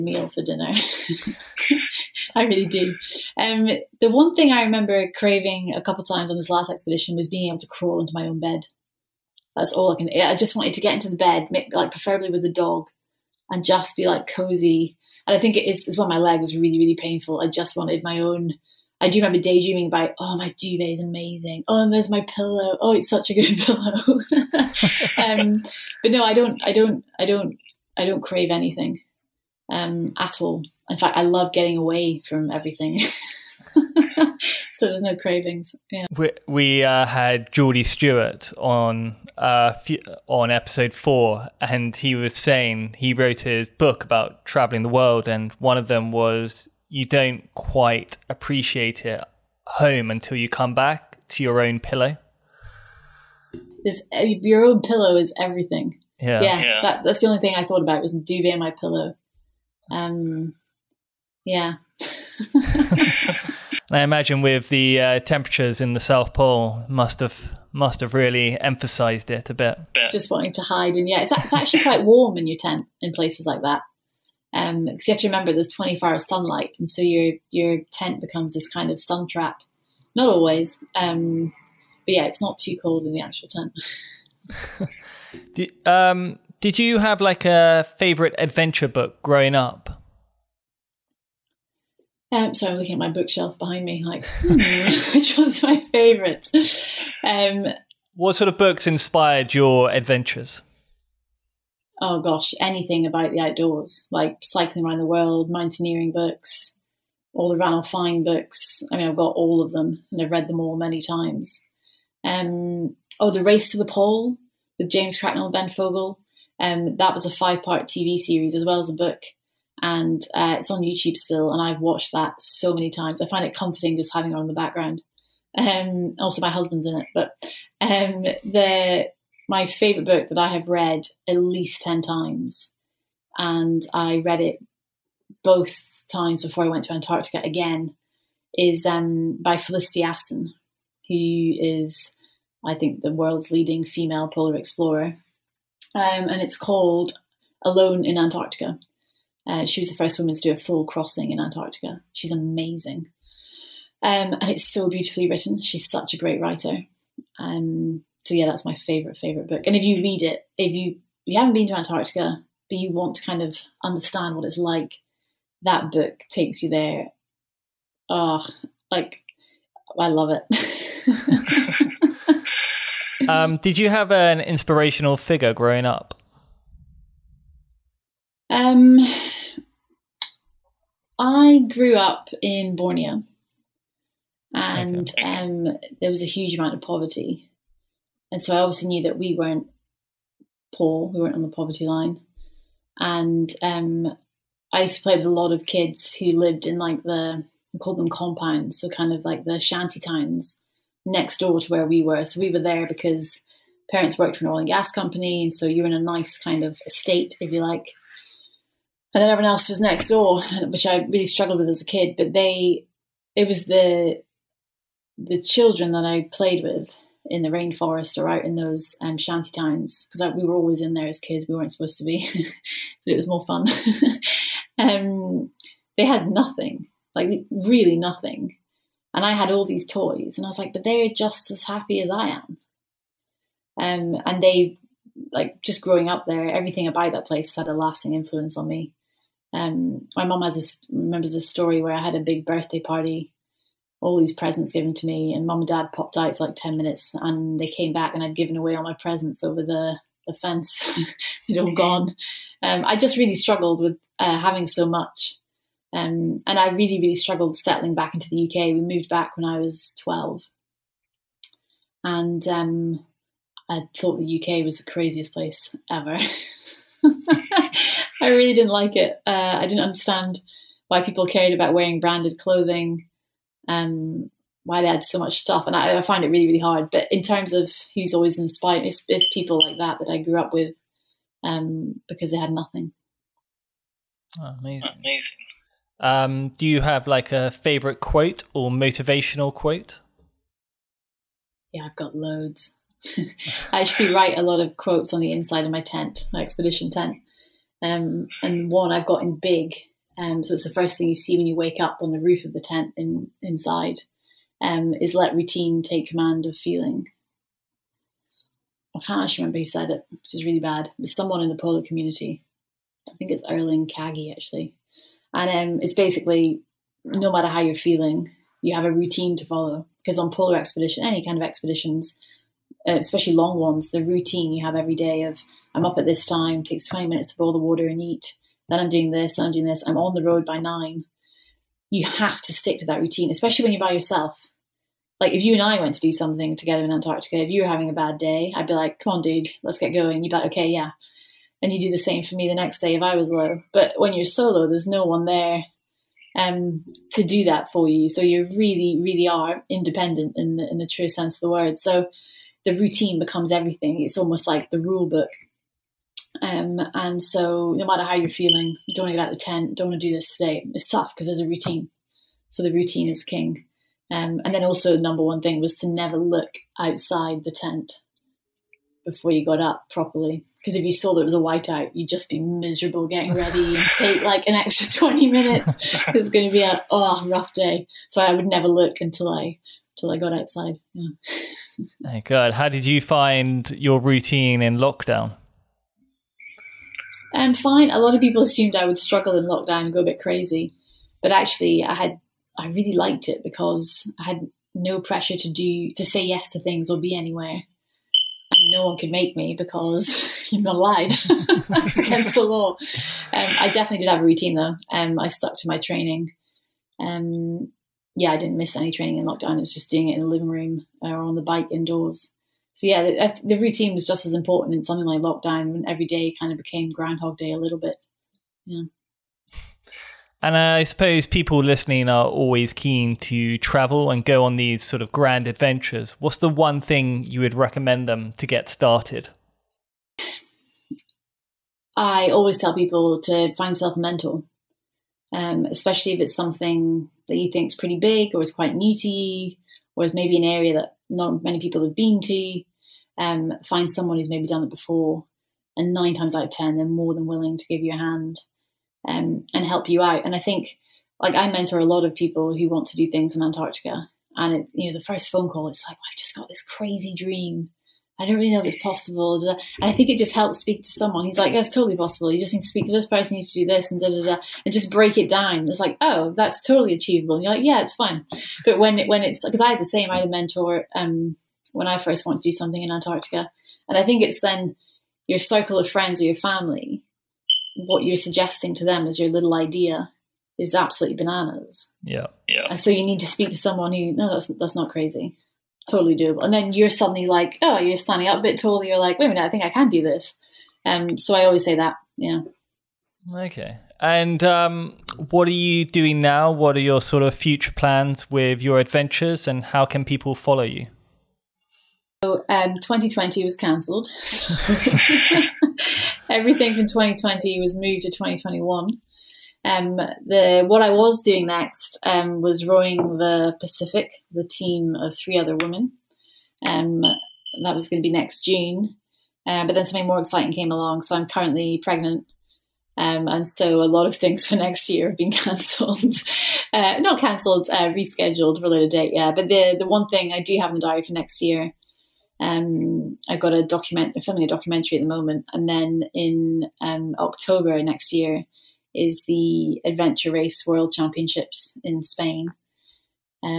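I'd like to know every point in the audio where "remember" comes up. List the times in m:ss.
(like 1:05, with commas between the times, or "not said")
0:04, 0:19, 1:15, 4:00, 5:09.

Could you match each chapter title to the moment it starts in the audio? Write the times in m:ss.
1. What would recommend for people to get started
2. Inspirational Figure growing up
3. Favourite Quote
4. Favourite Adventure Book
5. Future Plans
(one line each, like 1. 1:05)
1. 6:58
2. 2:51
3. 4:47
4. 1:37
5. 8:13.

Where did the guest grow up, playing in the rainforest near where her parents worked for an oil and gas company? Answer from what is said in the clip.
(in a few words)
Borneo.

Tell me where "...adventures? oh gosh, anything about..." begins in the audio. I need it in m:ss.
1:39.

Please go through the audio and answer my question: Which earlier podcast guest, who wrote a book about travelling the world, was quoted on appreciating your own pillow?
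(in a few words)
Geordie Stewart.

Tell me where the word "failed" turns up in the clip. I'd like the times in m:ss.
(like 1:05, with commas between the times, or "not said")
not said.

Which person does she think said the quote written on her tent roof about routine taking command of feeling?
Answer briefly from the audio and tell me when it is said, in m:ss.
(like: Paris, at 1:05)
Erling Kagge, at 5:13.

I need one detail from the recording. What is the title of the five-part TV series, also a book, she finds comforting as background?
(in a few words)
The Race to the Pole.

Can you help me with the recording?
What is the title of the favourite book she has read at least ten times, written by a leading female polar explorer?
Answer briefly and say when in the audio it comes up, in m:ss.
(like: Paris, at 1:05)
Alone in Antarctica, at 2:27.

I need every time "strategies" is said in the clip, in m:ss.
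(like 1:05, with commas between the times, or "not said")
not said.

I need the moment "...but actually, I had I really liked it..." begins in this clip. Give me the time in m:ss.
6:31.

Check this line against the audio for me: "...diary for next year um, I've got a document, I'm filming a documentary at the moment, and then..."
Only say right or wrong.
right.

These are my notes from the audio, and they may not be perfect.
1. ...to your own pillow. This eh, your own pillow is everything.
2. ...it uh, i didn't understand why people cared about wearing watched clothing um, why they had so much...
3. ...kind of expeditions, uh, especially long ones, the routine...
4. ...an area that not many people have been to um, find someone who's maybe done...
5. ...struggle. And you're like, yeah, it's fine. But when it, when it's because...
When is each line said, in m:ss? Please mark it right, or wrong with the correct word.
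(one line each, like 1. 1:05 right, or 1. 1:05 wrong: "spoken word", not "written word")
1. 0:51 right
2. 4:28 wrong: "branded", not "watched"
3. 5:21 right
4. 7:20 right
5. 7:46 wrong: "achievable", not "struggle".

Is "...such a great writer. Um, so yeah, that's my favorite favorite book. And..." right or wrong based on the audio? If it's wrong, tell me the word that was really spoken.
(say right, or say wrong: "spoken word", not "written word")
right.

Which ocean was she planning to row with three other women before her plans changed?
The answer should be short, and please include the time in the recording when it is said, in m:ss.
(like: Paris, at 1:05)
Pacific, at 8:33.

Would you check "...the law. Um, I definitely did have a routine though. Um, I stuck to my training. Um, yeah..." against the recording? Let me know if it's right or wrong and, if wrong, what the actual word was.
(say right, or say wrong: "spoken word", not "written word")
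right.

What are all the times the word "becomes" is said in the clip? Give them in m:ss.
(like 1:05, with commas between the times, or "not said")
1:18, 5:53.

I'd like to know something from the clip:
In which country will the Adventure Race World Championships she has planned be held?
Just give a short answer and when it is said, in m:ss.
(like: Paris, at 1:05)
Spain, at 9:02.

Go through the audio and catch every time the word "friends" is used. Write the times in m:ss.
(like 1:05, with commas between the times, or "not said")
7:55.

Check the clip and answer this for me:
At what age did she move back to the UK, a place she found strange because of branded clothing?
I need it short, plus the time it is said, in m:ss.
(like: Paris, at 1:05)
12, at 4:20.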